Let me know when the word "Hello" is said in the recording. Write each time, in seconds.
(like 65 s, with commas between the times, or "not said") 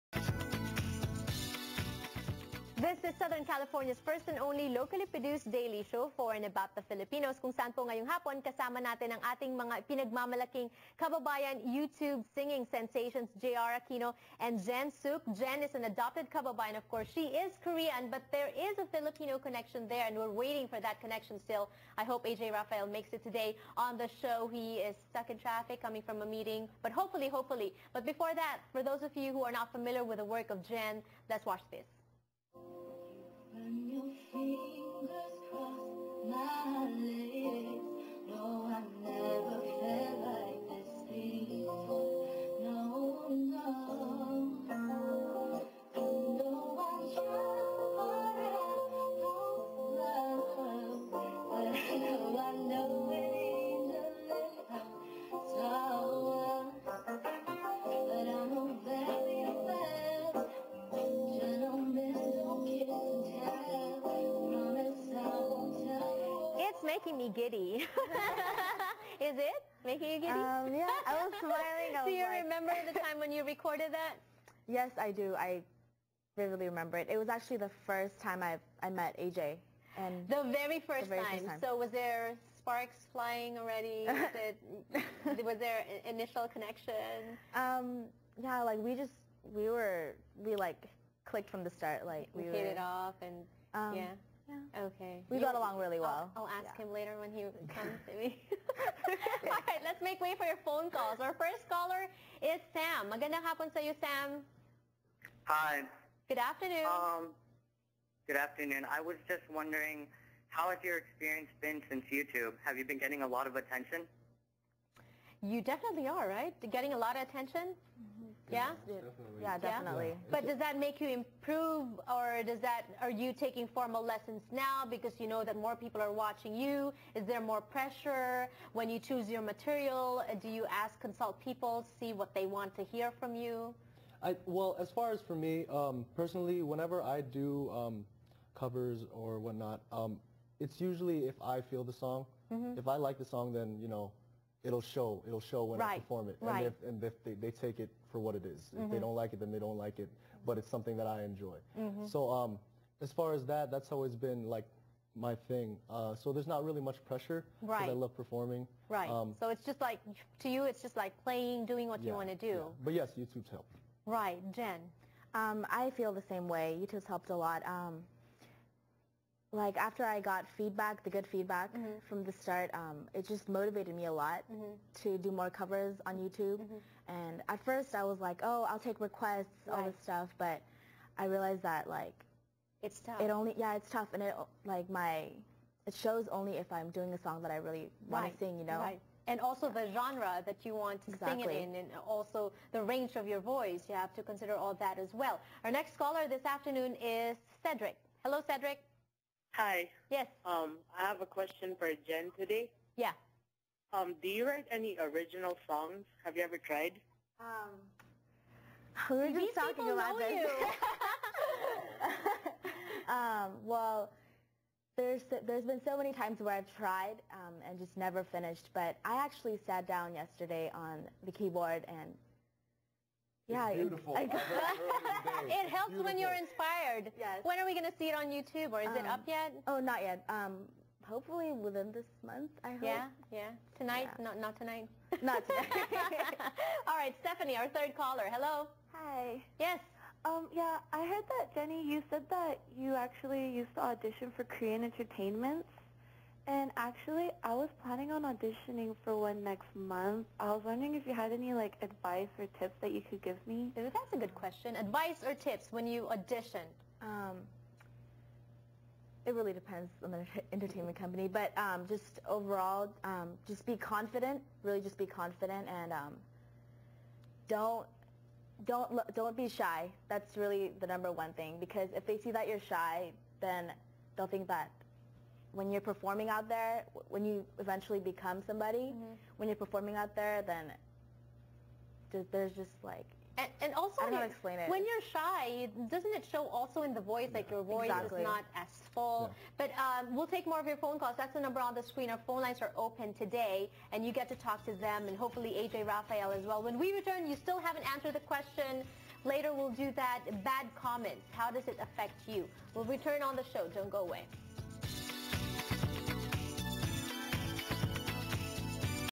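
198 s, 238 s.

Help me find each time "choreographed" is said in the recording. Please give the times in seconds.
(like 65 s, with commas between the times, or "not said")
not said.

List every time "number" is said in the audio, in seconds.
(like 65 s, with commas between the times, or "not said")
270 s, 291 s.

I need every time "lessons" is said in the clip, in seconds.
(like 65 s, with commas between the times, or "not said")
124 s.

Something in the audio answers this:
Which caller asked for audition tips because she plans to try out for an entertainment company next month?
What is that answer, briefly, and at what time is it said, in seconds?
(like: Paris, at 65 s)
Stephanie, at 237 s.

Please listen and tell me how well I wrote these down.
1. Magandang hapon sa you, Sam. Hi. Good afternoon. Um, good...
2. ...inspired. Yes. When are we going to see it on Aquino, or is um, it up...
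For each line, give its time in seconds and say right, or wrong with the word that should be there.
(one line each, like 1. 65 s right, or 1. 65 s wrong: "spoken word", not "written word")
1. 103 s right
2. 226 s wrong: "YouTube", not "Aquino".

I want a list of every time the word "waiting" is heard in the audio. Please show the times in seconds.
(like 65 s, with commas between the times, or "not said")
20 s.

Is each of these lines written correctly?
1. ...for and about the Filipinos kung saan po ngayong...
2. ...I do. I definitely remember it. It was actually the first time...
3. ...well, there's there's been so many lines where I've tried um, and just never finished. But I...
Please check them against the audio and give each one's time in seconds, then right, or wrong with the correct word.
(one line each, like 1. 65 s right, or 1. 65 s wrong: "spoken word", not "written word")
1. 6 s right
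2. 74 s wrong: "vividly", not "definitely"
3. 213 s wrong: "times", not "lines".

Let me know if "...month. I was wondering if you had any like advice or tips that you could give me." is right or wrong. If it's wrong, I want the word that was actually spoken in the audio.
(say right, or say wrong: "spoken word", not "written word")
right.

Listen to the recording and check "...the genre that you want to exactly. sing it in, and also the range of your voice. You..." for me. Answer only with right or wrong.
right.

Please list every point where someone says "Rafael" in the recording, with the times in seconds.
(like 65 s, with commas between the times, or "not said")
22 s, 295 s.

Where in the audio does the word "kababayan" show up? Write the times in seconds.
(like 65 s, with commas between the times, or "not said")
10 s, 16 s.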